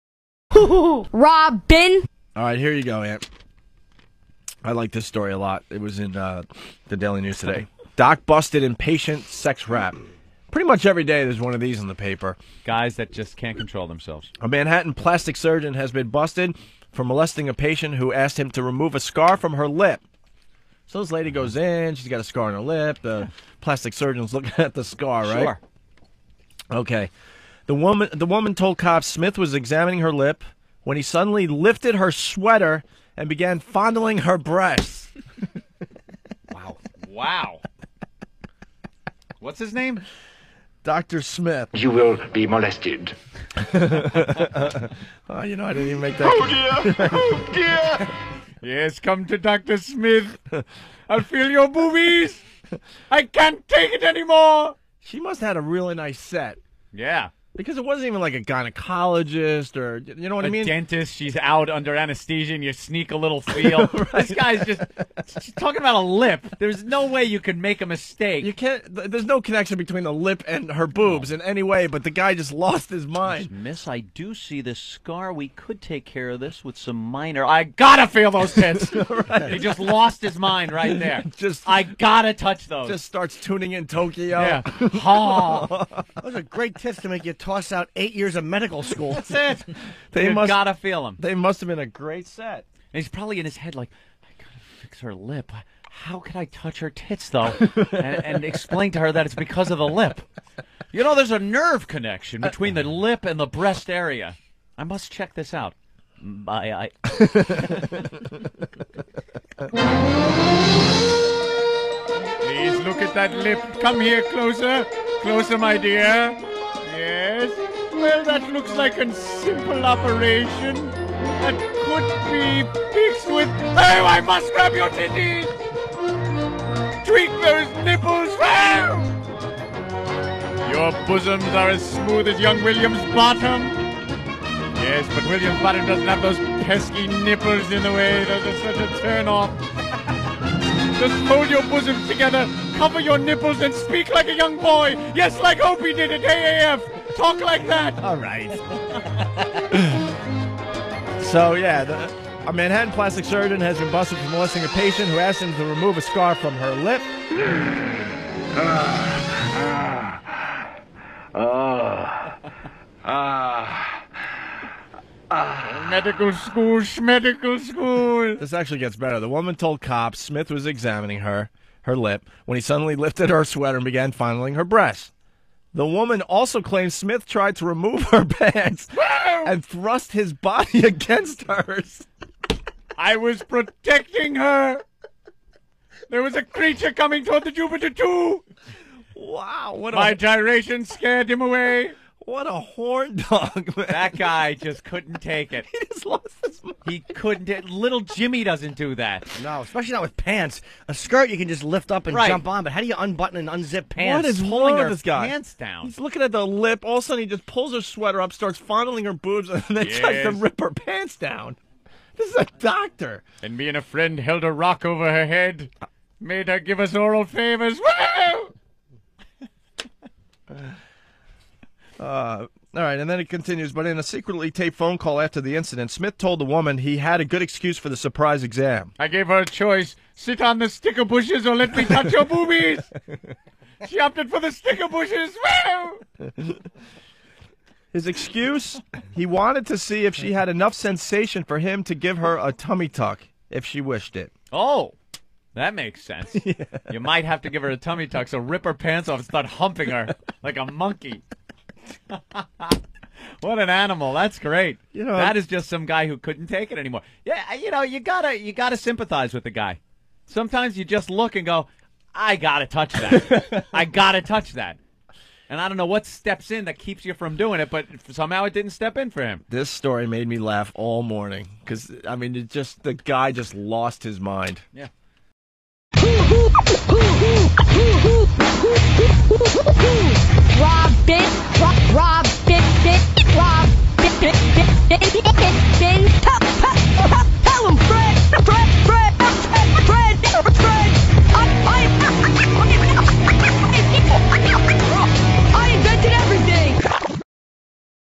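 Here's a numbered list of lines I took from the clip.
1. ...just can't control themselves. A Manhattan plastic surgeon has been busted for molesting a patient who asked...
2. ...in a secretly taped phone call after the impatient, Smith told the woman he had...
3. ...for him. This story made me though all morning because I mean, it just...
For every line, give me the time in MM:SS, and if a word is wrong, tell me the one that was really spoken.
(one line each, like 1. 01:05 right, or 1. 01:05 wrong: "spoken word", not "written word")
1. 00:13 right
2. 03:43 wrong: "incident", not "impatient"
3. 04:29 wrong: "laugh", not "though".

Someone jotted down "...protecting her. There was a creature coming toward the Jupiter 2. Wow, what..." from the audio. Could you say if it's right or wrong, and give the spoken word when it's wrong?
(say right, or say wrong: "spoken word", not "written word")
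right.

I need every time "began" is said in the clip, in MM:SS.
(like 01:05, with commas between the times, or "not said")
00:33, 02:53.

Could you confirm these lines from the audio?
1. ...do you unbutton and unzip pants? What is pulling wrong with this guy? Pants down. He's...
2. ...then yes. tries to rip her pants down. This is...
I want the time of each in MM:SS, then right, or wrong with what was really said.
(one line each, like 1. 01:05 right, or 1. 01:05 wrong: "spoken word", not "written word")
1. 03:22 right
2. 03:29 right.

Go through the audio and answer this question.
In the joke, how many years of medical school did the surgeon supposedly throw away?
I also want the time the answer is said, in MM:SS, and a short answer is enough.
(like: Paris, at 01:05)
8, at 01:27.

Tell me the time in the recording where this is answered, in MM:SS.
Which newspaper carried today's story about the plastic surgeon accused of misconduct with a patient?
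00:06.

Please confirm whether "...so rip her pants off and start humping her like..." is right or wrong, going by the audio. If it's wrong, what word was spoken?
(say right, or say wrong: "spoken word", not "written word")
right.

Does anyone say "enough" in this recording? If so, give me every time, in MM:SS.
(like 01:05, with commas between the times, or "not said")
04:00.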